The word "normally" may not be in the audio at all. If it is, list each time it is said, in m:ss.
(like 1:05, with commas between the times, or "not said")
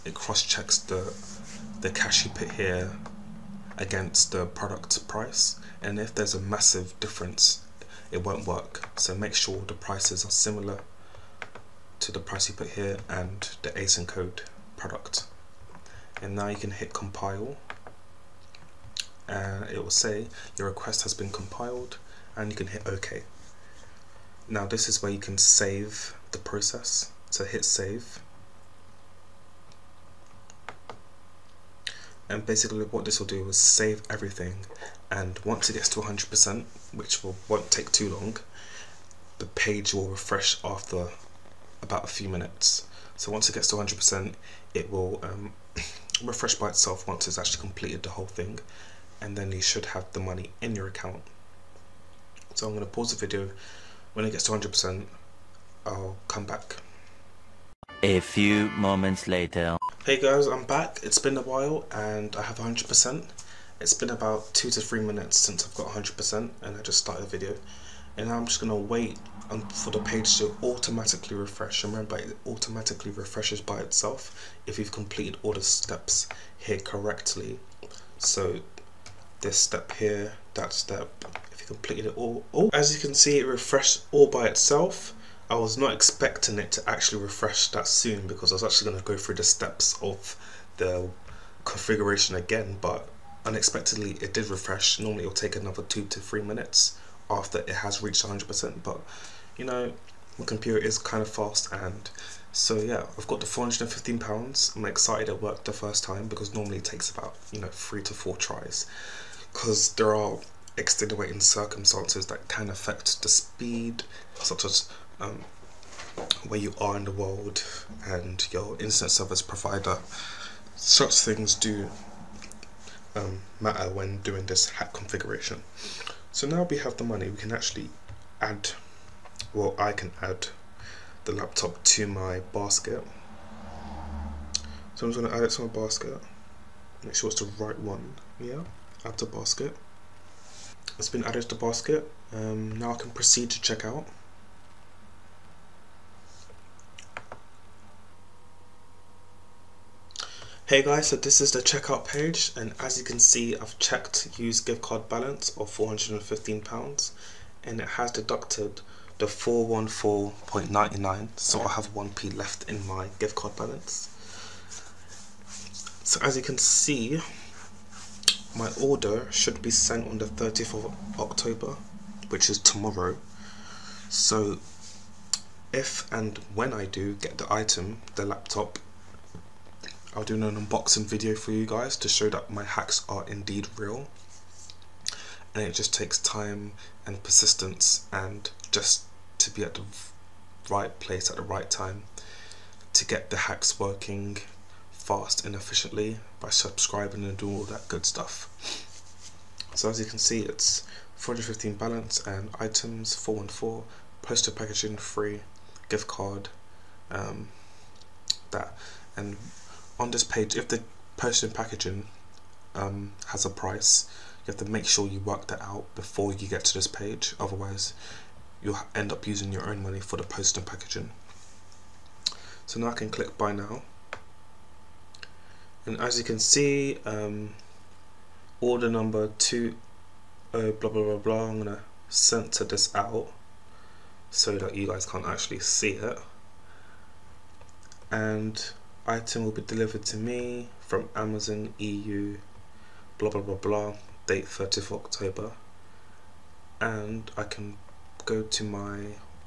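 1:34, 1:46.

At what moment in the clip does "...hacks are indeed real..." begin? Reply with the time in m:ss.
3:02.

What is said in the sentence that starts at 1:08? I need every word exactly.
And I'm just going to wait for the page to automatically refresh.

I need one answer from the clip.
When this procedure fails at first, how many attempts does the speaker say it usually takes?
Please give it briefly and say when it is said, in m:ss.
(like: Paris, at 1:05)
3 to 4 tries, at 1:47.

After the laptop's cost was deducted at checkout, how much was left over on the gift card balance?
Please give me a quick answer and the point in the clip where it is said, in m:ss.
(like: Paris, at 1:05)
1p, at 2:41.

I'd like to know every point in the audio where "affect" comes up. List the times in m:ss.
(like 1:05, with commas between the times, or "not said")
1:52.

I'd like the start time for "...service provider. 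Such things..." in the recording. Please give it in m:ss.
1:59.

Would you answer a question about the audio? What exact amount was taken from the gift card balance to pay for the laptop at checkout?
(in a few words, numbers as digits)
£414.99.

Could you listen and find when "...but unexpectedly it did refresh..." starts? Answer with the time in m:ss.
1:32.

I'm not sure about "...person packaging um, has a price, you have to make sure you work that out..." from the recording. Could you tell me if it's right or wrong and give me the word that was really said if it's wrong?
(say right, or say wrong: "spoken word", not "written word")
right.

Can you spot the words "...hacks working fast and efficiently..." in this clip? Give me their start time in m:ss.
3:13.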